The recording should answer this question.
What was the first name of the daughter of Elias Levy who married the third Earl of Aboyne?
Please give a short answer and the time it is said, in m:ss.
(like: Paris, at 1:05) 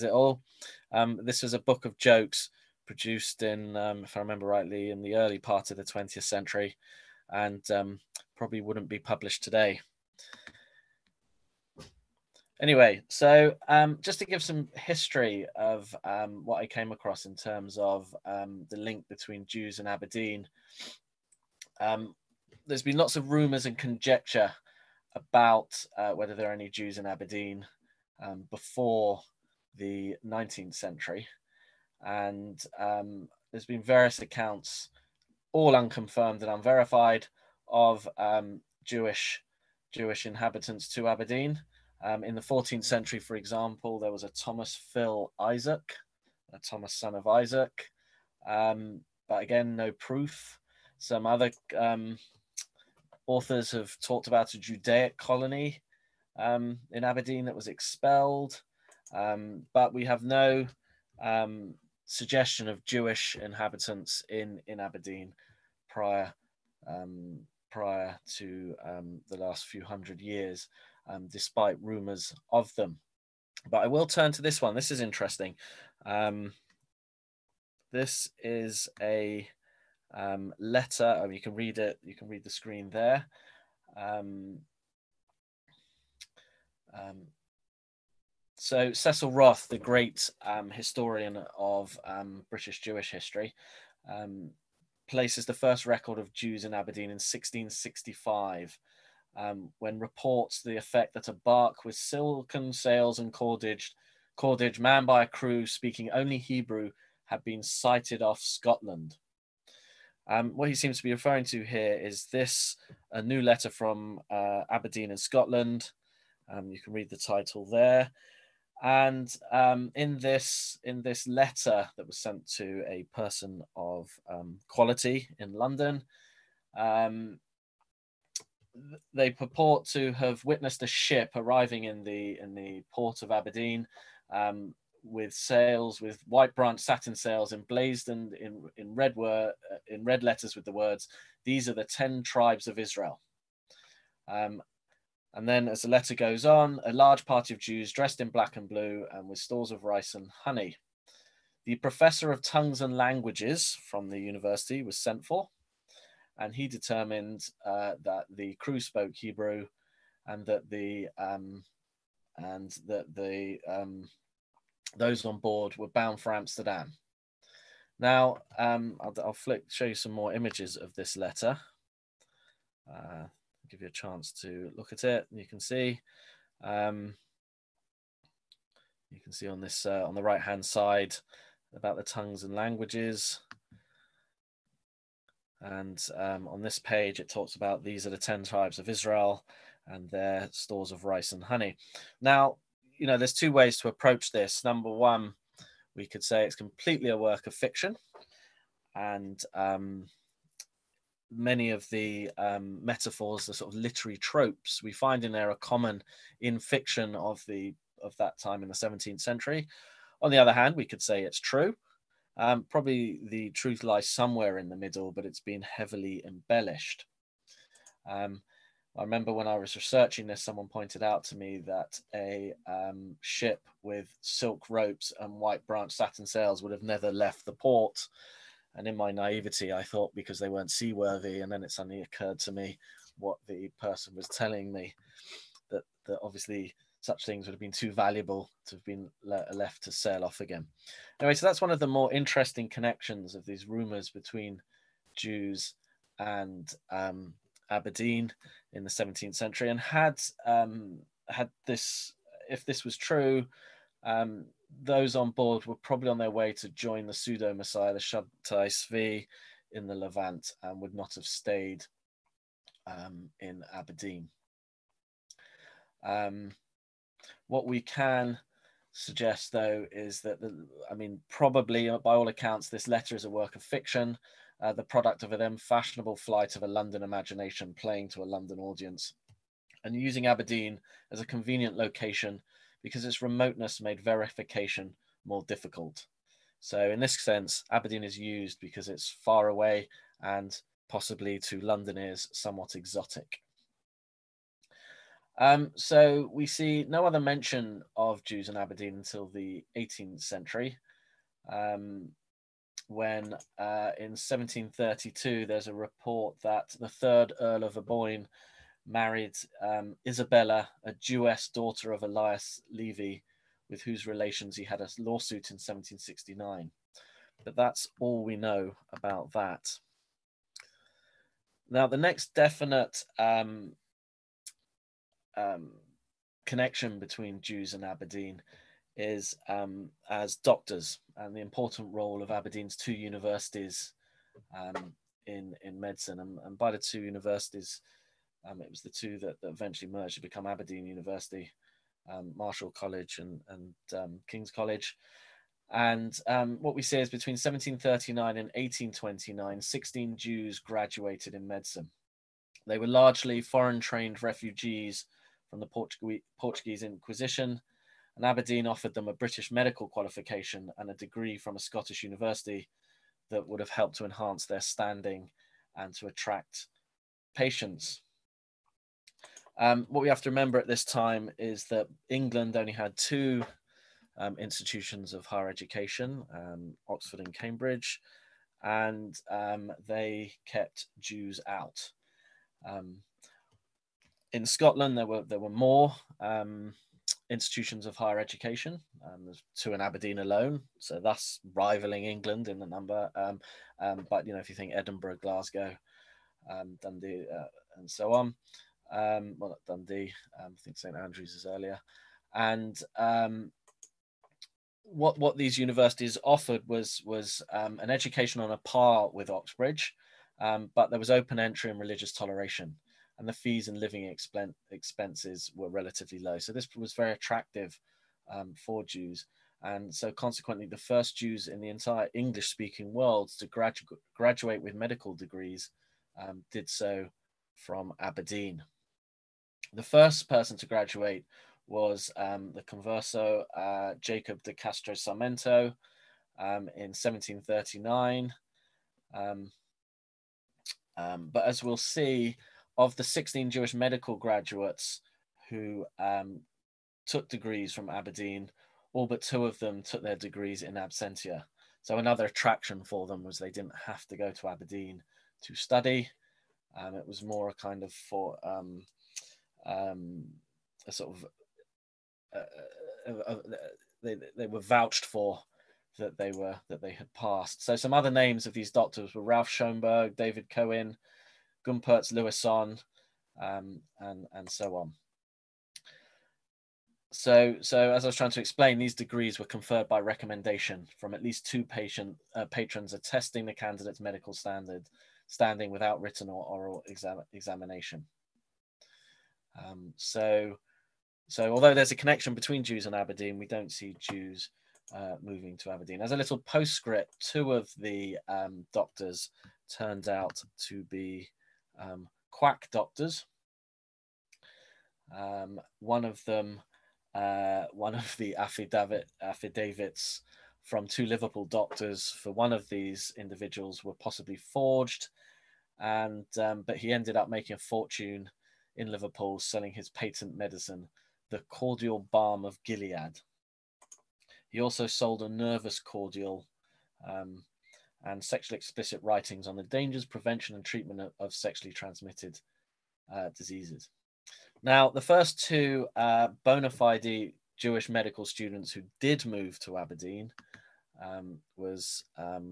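Isabella, at 5:10.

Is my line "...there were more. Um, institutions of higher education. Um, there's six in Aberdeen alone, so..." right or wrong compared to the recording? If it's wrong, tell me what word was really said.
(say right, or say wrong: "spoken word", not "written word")
wrong: "two", not "six".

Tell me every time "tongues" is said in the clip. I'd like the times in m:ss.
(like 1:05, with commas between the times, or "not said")
2:32, 3:02.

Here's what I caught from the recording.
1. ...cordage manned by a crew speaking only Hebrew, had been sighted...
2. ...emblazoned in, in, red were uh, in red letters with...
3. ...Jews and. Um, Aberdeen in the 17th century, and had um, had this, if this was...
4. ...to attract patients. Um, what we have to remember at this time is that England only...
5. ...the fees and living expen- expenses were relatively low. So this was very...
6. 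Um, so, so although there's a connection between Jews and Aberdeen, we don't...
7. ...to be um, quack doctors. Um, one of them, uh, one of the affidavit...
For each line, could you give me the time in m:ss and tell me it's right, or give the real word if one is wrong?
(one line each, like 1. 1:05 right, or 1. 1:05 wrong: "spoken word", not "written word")
1. 1:44 right
2. 2:17 right
3. 4:05 right
4. 6:05 right
5. 6:53 right
6. 8:09 right
7. 8:20 right.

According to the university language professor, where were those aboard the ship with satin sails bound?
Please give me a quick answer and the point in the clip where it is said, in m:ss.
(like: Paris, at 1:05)
Amsterdam, at 2:46.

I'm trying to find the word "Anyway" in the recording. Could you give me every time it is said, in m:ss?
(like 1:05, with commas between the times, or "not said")
0:12, 4:01.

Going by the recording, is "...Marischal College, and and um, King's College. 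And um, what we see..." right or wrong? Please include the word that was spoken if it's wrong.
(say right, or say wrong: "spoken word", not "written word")
right.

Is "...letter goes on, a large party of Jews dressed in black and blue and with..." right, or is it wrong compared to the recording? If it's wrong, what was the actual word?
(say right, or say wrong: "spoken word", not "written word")
right.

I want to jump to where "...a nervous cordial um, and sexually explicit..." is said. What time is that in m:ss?
8:45.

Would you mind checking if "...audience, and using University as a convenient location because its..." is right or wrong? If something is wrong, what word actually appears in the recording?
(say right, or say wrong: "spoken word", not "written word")
wrong: "Aberdeen", not "University".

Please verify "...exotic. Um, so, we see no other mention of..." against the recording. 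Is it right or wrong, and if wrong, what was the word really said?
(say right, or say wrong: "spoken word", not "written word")
right.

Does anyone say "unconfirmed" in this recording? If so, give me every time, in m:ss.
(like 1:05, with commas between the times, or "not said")
0:35.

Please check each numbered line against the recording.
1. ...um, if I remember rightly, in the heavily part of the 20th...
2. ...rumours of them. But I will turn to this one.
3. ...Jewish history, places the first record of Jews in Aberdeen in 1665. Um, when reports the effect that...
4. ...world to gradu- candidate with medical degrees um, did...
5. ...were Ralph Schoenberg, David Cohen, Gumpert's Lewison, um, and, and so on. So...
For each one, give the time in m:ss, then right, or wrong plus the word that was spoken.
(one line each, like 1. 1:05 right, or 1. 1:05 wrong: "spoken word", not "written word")
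1. 0:03 wrong: "early", not "heavily"
2. 1:11 right
3. 1:32 right
4. 7:02 wrong: "graduate", not "candidate"
5. 7:49 right.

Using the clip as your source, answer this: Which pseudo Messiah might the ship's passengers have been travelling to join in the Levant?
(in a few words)
Shabtai Zvi.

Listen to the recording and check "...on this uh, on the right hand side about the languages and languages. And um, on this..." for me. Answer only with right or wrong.
wrong.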